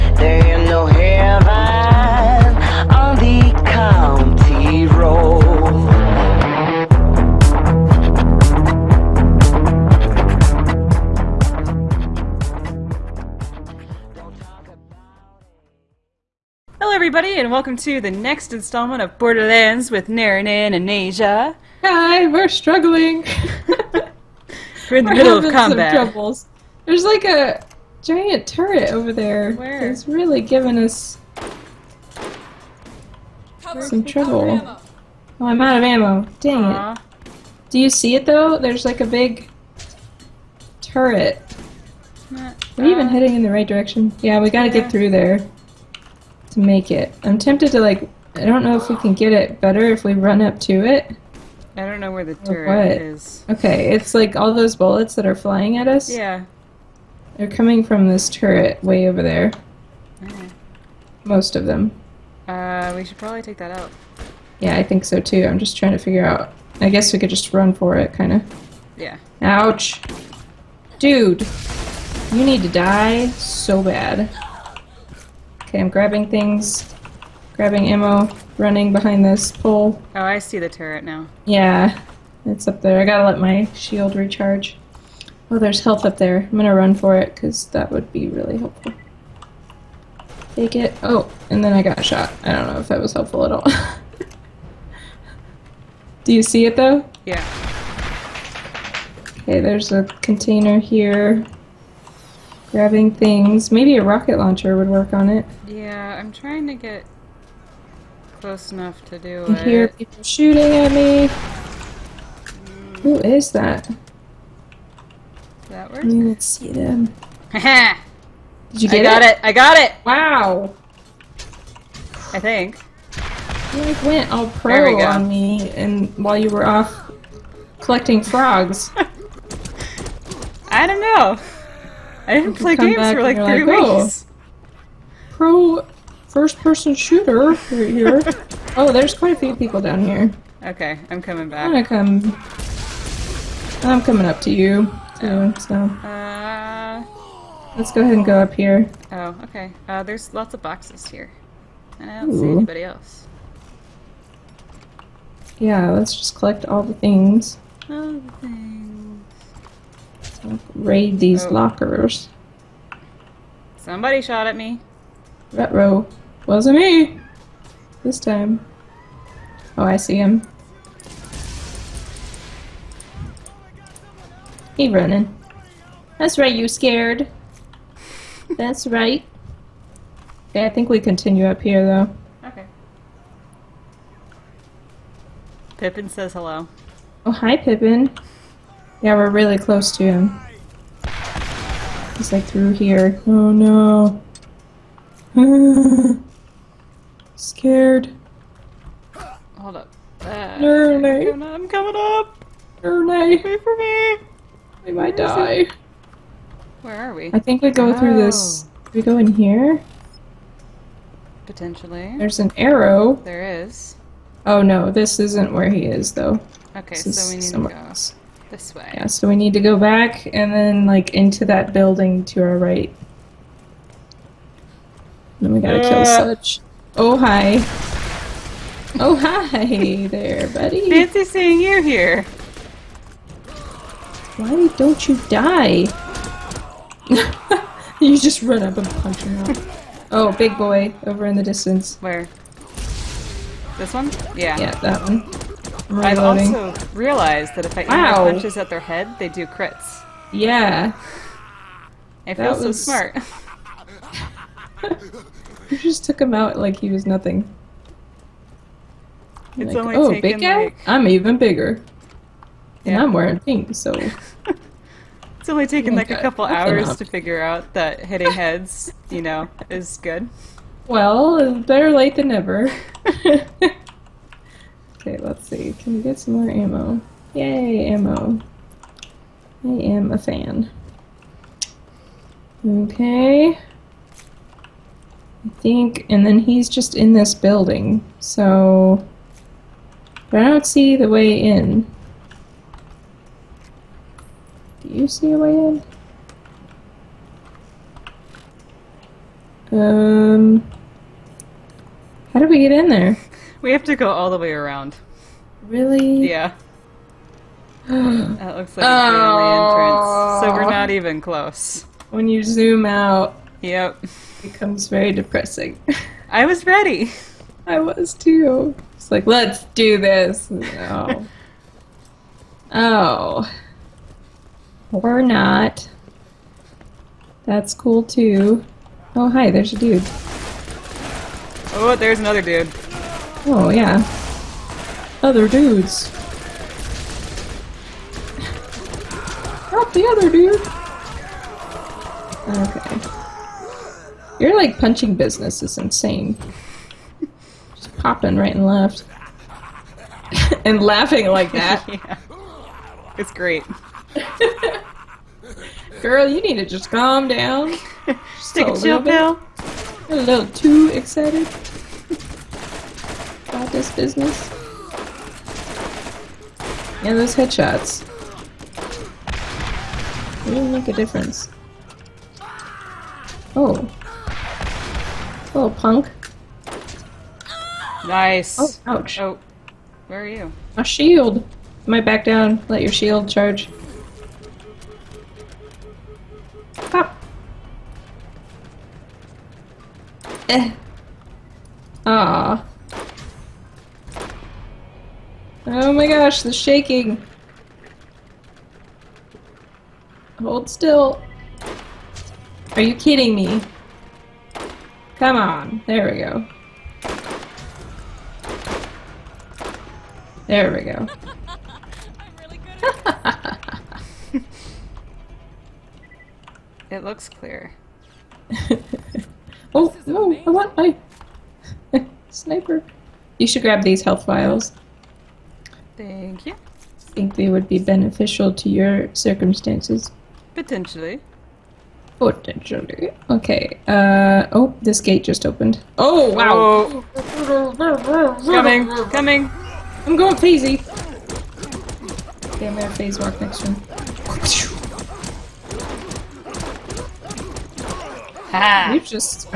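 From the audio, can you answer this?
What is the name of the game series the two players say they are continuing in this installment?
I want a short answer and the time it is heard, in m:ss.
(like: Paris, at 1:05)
Borderlands, at 0:19.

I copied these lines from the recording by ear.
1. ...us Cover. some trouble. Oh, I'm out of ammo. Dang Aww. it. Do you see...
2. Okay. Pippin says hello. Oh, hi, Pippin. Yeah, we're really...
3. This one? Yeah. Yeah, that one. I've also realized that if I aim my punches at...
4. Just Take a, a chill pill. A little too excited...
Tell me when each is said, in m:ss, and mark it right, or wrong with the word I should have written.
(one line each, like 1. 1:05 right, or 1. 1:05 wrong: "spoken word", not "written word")
1. 0:30 right
2. 3:02 right
3. 4:03 right
4. 5:58 right.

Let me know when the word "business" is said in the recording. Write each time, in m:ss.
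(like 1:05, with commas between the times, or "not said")
5:45, 6:03.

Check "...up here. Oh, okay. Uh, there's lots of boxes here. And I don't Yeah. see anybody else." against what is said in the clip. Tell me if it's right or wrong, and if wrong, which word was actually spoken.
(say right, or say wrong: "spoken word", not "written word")
wrong: "Ooh", not "Yeah".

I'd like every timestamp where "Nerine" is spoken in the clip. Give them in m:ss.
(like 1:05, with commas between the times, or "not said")
0:20, 3:22.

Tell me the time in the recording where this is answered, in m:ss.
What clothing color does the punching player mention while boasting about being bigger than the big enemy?
4:23.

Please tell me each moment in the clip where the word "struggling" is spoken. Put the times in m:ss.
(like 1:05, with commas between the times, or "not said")
0:22.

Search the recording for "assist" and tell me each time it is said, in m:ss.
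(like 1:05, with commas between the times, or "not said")
not said.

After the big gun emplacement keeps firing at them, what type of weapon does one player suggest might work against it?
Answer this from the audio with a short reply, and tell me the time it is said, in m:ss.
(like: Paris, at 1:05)
rocket launcher, at 1:44.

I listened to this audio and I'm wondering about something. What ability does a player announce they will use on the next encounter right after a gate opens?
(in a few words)
phase walk.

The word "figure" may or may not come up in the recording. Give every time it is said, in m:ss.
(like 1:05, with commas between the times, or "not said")
1:05, 4:27.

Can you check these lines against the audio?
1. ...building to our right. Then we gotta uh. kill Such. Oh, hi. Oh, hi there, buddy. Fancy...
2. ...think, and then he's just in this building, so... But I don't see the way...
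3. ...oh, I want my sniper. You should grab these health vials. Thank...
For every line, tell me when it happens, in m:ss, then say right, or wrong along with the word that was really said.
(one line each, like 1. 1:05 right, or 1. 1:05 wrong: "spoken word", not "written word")
1. 3:41 right
2. 4:45 right
3. 7:00 right.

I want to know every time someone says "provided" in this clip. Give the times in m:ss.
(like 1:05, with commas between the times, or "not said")
not said.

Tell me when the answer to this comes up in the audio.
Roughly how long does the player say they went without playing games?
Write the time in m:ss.
2:13.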